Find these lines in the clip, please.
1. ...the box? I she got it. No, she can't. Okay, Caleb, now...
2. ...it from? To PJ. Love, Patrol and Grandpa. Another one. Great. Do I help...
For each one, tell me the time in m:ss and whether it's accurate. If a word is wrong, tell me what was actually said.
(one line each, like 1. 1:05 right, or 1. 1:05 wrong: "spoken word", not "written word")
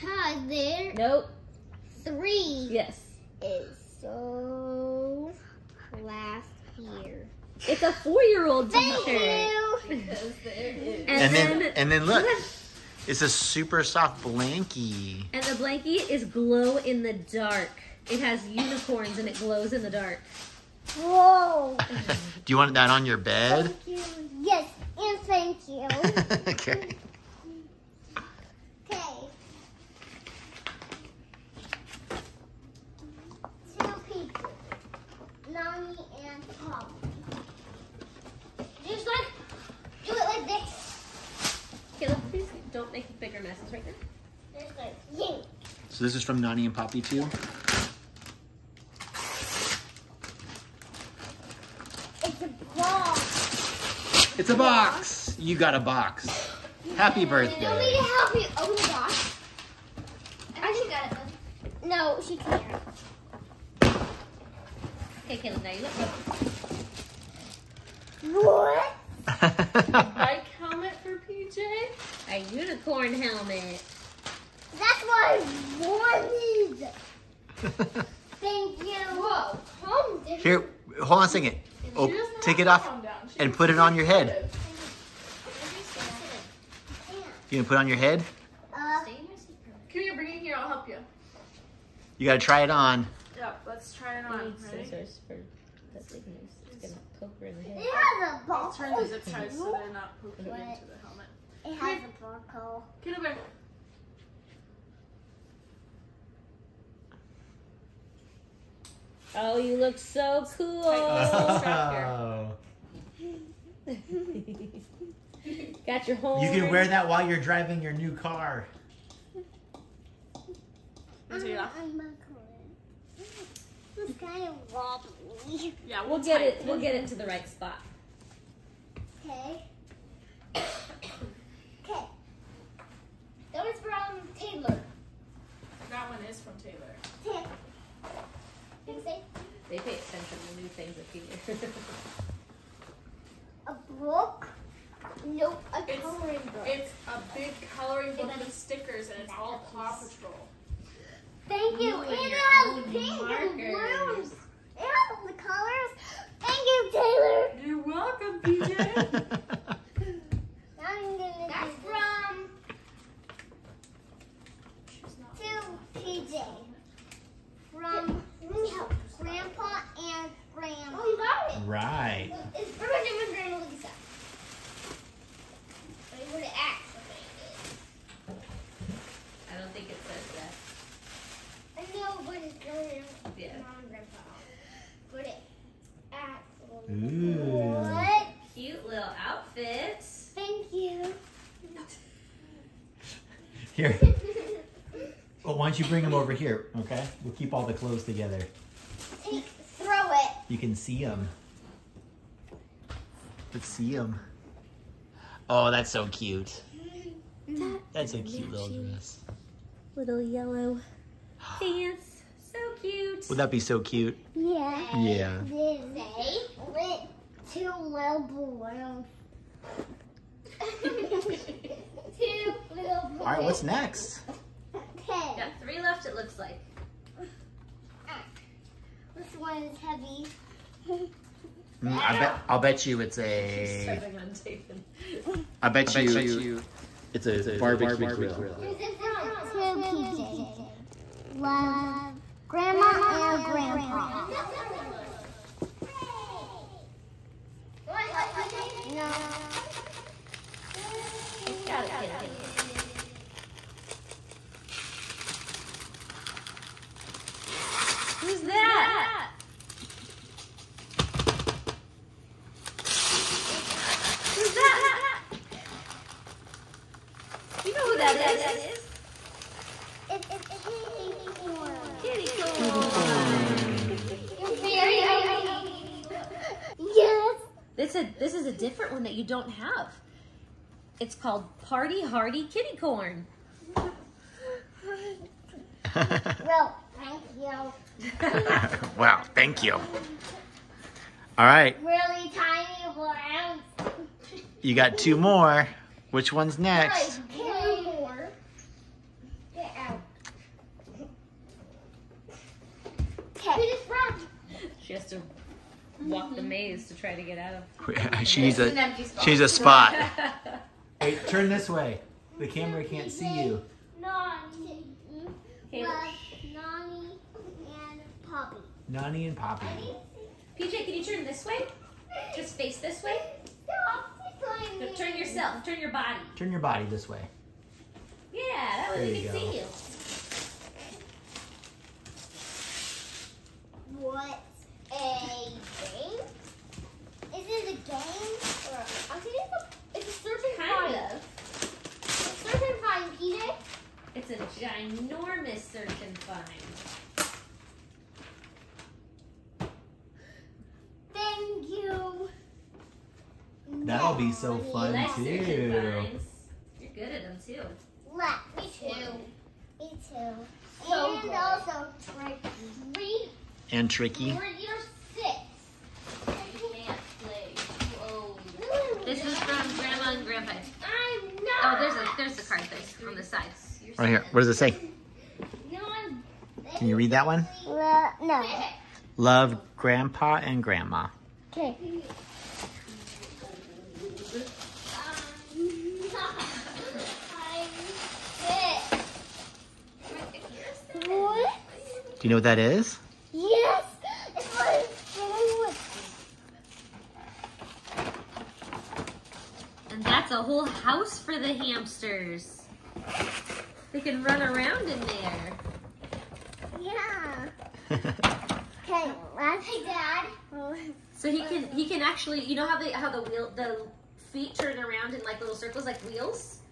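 1. 0:58 right
2. 3:58 wrong: "Grandma", not "Patrol".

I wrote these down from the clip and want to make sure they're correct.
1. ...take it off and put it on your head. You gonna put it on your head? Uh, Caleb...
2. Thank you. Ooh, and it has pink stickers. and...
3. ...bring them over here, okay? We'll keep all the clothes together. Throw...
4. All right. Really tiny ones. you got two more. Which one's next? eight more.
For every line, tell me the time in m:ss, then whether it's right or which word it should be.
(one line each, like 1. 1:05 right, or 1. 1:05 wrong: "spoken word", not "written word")
1. 1:22 wrong: "Come", not "Caleb"
2. 2:31 wrong: "markers", not "stickers"
3. 3:15 right
4. 4:49 wrong: "two", not "eight".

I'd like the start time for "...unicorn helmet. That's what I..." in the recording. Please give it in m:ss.
1:12.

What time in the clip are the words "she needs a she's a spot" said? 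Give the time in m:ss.
5:08.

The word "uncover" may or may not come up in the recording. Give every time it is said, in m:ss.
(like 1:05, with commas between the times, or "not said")
not said.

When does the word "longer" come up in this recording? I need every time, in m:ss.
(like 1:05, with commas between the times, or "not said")
not said.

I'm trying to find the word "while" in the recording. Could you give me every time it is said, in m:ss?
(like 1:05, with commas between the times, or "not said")
1:57.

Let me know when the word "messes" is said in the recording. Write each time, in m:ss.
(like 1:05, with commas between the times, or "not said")
0:43.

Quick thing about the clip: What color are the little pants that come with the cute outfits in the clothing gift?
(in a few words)
Yellow.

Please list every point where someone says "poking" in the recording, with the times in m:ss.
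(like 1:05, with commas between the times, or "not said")
1:40.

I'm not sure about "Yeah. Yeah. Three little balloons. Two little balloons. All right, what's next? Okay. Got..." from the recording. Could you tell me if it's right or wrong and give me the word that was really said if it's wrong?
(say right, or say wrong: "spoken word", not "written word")
wrong: "Two", not "Three".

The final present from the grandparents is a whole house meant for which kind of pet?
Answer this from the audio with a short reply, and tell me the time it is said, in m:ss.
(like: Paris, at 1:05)
Hamsters, at 6:41.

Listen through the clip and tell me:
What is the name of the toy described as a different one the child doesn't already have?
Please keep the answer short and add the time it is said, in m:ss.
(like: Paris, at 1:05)
Party Hardy Kitty Corn, at 4:41.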